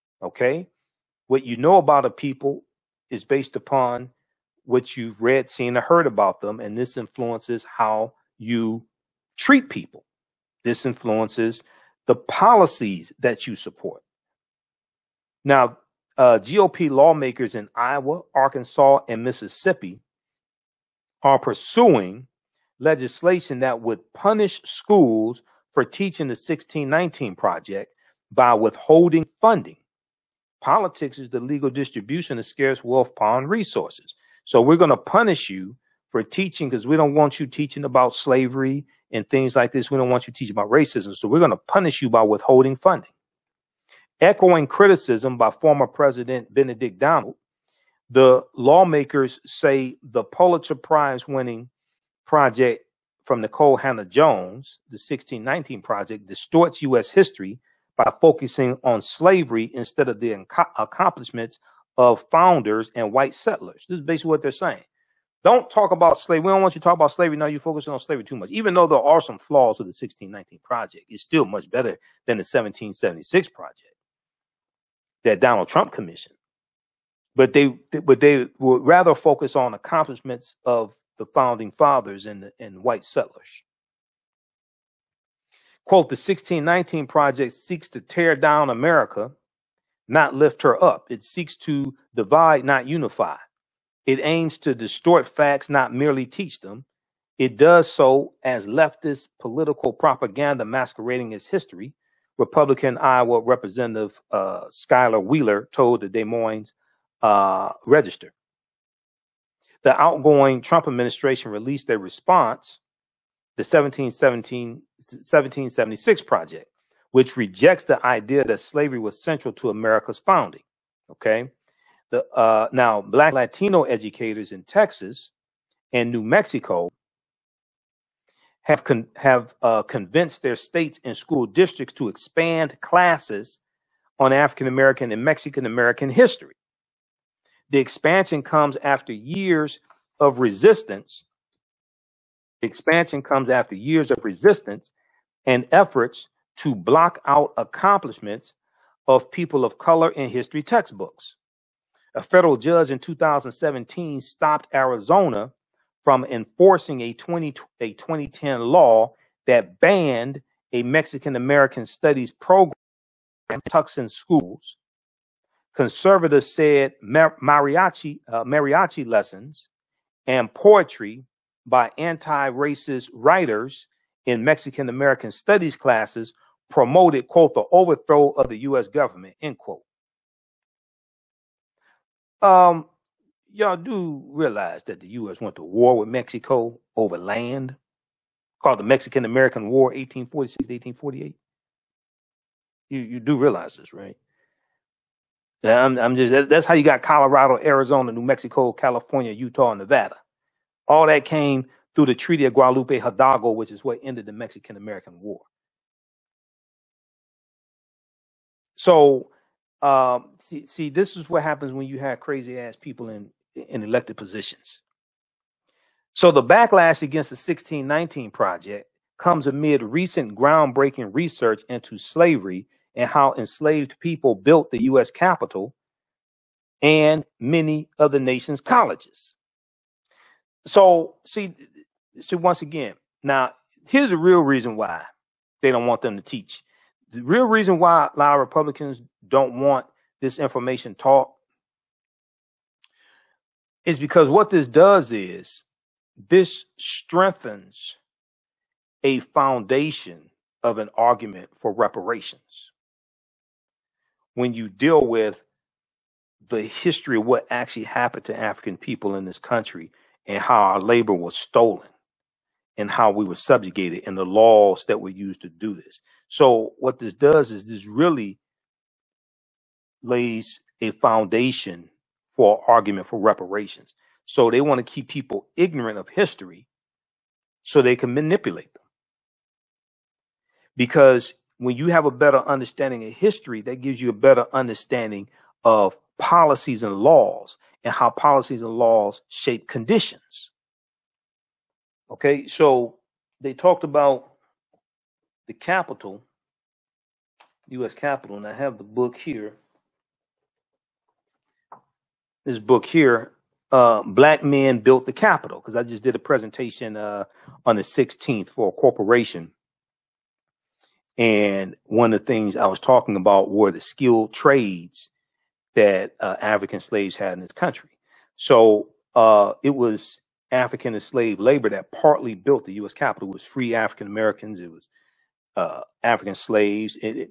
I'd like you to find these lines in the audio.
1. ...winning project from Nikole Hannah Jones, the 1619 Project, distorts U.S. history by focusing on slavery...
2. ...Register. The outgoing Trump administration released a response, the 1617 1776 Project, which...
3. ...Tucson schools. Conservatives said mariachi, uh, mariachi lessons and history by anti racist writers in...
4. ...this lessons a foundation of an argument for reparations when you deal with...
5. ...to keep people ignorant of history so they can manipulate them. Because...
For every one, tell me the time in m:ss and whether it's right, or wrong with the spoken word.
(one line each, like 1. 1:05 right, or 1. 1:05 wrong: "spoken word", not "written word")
1. 0:51 right
2. 1:47 wrong: "1717", not "1617"
3. 2:43 wrong: "poetry", not "history"
4. 4:06 wrong: "strengthens", not "lessons"
5. 4:34 right.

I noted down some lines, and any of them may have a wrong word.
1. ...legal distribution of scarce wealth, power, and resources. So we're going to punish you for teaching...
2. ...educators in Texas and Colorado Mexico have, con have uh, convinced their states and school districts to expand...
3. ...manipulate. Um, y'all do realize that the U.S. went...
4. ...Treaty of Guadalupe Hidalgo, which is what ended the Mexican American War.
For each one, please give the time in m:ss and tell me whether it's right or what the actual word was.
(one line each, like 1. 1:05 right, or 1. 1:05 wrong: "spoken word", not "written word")
1. 0:31 right
2. 2:03 wrong: "New", not "Colorado"
3. 2:59 wrong: "quote", not "manipulate"
4. 3:22 right.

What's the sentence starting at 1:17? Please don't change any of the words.
But they, but they would rather focus on accomplishments of the founding fathers and the, and white settlers.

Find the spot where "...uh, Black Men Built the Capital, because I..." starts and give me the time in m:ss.
5:03.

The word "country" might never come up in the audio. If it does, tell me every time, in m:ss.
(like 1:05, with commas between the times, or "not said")
4:19, 5:17.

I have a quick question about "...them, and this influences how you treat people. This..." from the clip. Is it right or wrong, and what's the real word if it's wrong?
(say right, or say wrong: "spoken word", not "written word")
right.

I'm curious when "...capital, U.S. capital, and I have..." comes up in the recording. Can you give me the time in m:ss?
4:55.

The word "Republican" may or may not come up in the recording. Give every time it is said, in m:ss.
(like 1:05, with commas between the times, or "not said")
1:42, 3:58.